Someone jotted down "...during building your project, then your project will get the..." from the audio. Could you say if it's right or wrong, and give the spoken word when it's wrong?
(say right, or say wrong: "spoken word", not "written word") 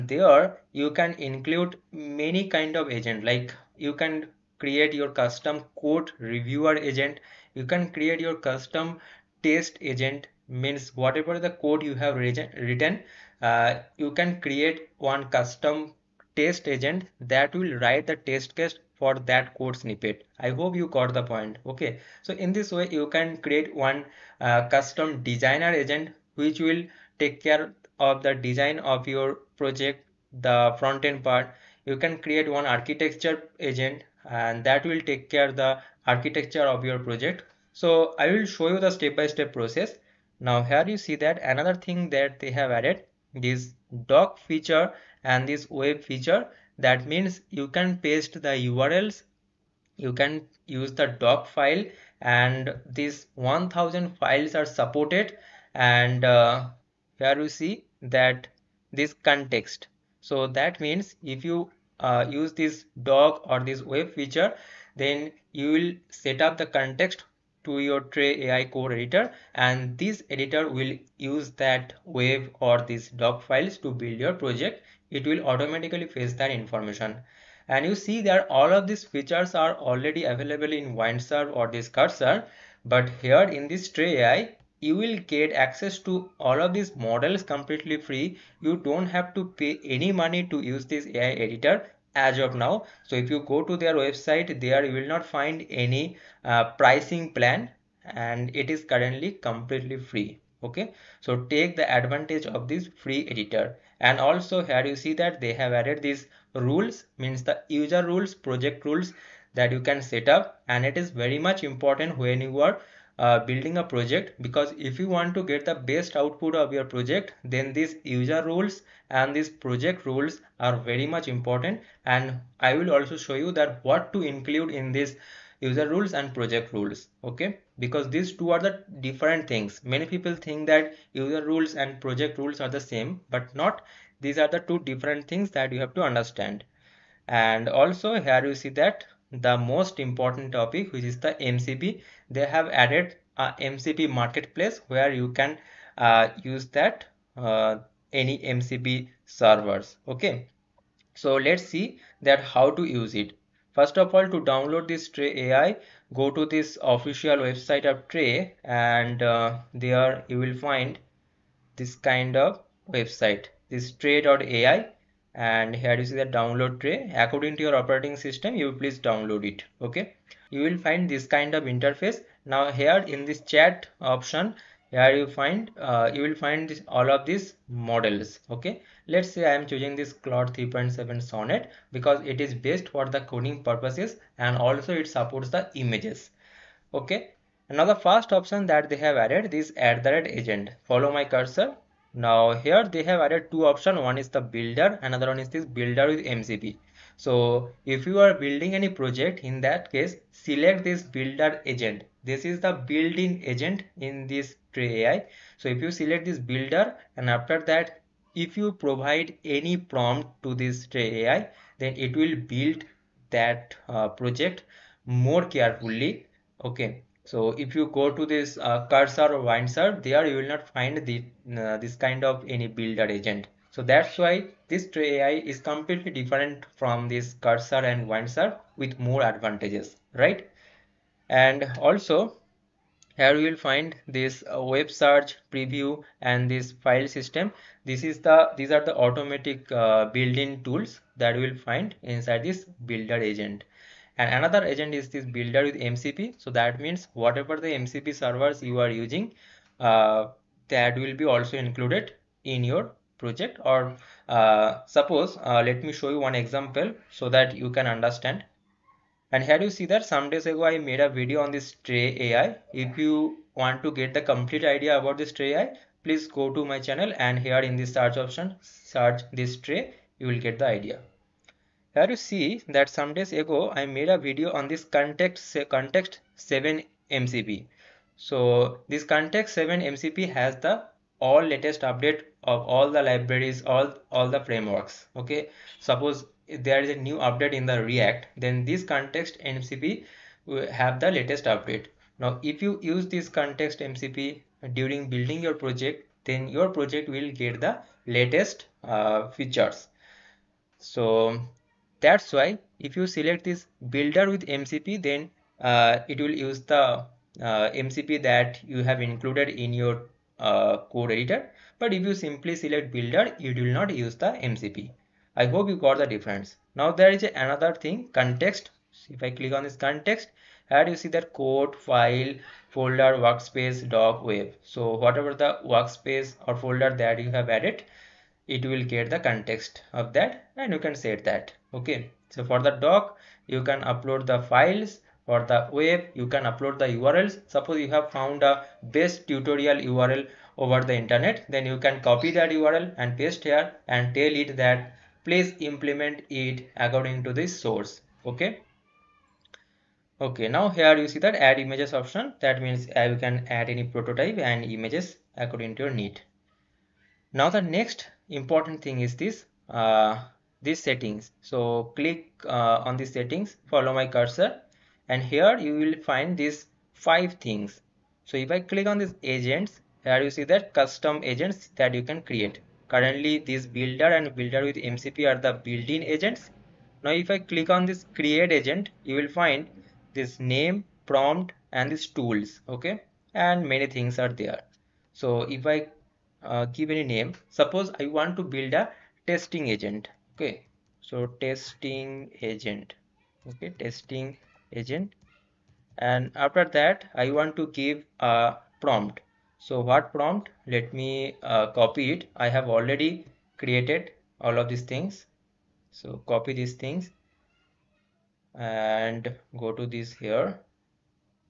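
right.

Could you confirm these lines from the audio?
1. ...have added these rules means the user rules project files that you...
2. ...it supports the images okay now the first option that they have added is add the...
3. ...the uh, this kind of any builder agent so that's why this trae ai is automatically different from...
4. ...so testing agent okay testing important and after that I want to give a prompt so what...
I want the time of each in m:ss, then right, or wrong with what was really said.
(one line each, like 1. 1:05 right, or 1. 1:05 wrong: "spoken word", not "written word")
1. 1:45 wrong: "rules", not "files"
2. 3:04 right
3. 3:41 wrong: "completely", not "automatically"
4. 6:31 wrong: "agent", not "important".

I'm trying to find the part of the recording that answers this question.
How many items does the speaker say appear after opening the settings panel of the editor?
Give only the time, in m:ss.
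6:06.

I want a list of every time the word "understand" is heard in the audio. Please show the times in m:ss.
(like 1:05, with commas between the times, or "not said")
2:16, 4:17.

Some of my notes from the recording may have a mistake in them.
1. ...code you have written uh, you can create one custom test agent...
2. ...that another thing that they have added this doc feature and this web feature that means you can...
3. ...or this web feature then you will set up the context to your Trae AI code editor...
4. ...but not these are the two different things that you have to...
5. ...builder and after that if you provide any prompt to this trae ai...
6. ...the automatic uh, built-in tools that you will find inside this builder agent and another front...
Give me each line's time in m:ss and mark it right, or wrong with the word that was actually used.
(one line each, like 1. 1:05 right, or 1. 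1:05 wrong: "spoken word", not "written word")
1. 0:11 right
2. 0:41 right
3. 1:03 right
4. 2:13 right
5. 3:26 right
6. 3:58 wrong: "agent", not "front".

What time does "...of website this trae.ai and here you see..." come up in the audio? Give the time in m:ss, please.
2:42.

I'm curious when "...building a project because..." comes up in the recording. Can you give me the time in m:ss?
1:53.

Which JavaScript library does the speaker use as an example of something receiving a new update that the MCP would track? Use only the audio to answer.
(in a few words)
React.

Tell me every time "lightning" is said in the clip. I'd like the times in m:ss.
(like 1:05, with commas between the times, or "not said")
not said.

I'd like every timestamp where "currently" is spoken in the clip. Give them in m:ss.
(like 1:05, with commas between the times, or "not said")
1:38, 6:12.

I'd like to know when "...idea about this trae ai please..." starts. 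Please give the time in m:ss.
4:24.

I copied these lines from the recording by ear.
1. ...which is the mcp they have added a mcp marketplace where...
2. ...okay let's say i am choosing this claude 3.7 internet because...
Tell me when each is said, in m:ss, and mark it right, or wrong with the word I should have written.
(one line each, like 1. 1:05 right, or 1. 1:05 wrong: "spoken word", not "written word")
1. 2:20 right
2. 2:58 wrong: "sonnet", not "internet".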